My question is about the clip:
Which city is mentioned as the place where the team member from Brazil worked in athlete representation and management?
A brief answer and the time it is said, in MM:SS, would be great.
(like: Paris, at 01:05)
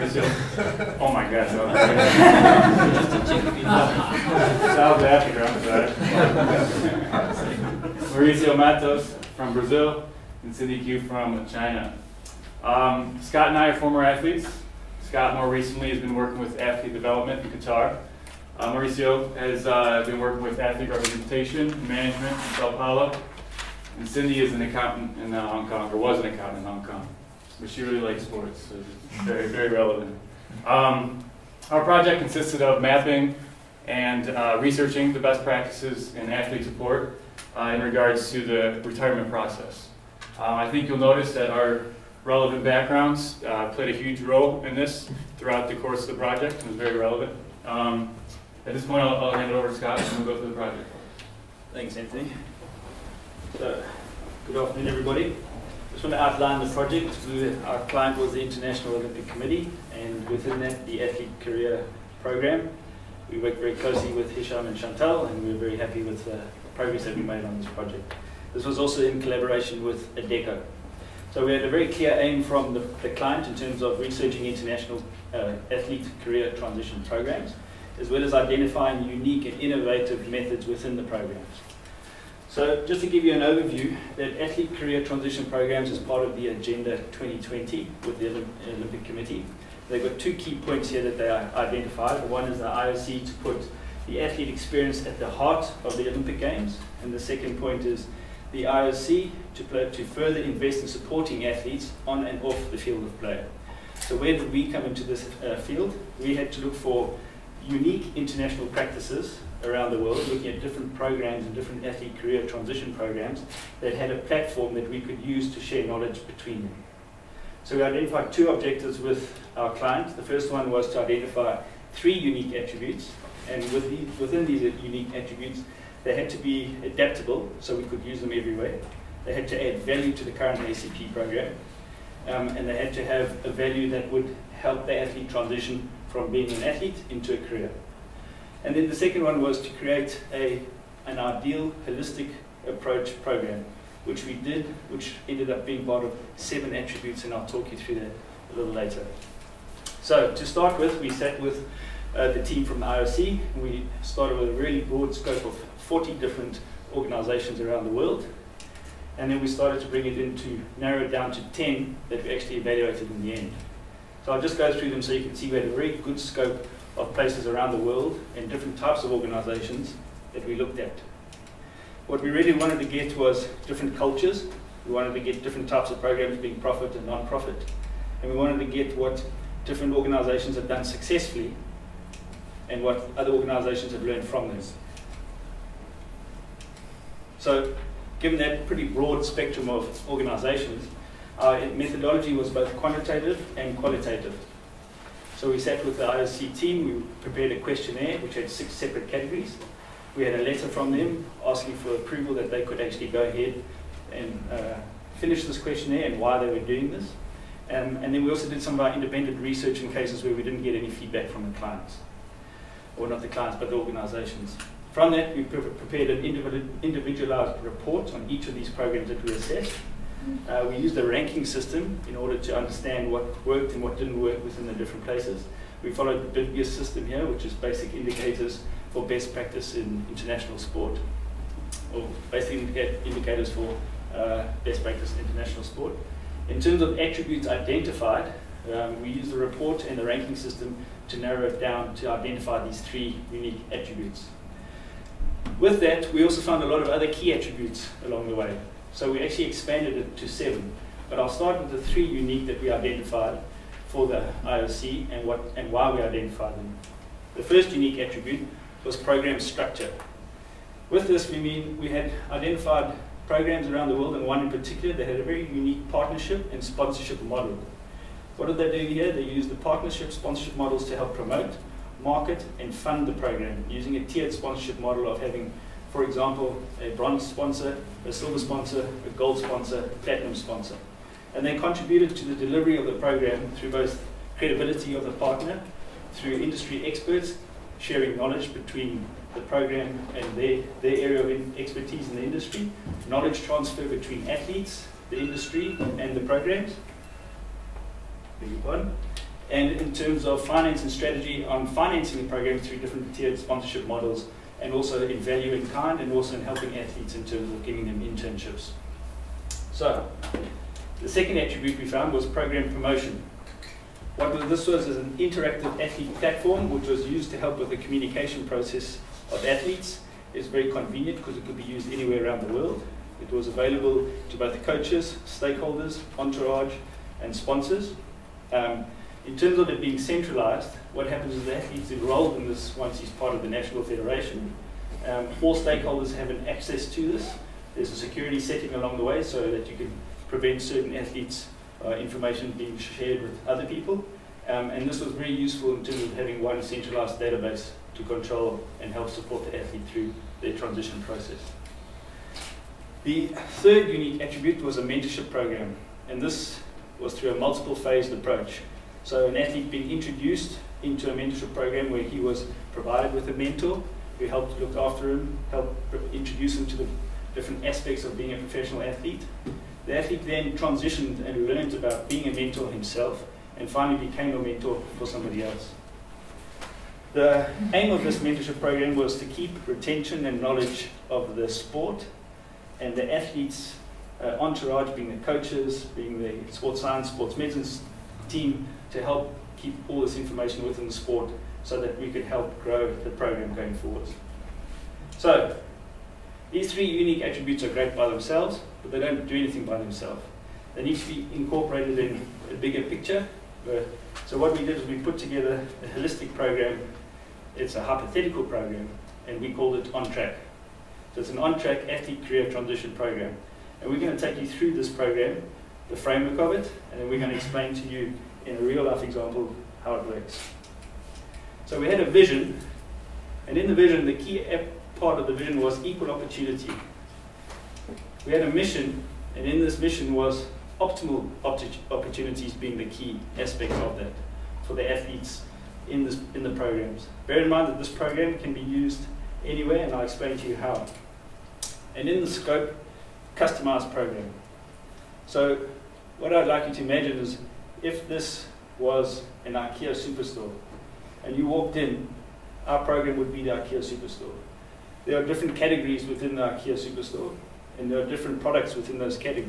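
Sao Paulo, at 00:22.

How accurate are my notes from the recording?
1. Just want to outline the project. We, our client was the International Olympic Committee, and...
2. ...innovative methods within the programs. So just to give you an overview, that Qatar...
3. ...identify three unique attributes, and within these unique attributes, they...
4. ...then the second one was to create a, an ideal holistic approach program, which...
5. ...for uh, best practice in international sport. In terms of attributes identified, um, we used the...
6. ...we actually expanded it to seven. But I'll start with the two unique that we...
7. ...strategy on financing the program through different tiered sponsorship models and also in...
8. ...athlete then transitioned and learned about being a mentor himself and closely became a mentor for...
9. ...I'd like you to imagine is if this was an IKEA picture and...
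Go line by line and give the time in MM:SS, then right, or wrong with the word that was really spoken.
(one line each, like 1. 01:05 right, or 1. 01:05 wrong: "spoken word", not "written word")
1. 00:55 right
2. 01:19 wrong: "Athlete", not "Qatar"
3. 02:01 right
4. 02:18 right
5. 03:53 right
6. 04:09 wrong: "three", not "two"
7. 05:00 right
8. 06:09 wrong: "finally", not "closely"
9. 07:26 wrong: "superstore", not "picture".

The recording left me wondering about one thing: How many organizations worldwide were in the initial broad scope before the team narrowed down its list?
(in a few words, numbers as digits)
40.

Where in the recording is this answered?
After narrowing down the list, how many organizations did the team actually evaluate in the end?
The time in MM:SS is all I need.
02:41.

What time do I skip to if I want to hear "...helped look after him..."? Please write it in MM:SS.
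06:04.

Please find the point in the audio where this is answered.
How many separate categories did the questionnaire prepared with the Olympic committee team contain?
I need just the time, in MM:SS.
03:18.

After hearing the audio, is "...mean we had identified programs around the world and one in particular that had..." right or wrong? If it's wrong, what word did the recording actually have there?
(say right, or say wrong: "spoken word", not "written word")
right.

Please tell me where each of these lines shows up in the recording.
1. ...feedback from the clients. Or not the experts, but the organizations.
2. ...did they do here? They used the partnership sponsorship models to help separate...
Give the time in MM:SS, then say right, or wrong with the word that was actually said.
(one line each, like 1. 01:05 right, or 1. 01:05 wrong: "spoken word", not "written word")
1. 03:30 wrong: "clients", not "experts"
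2. 04:28 wrong: "promote", not "separate".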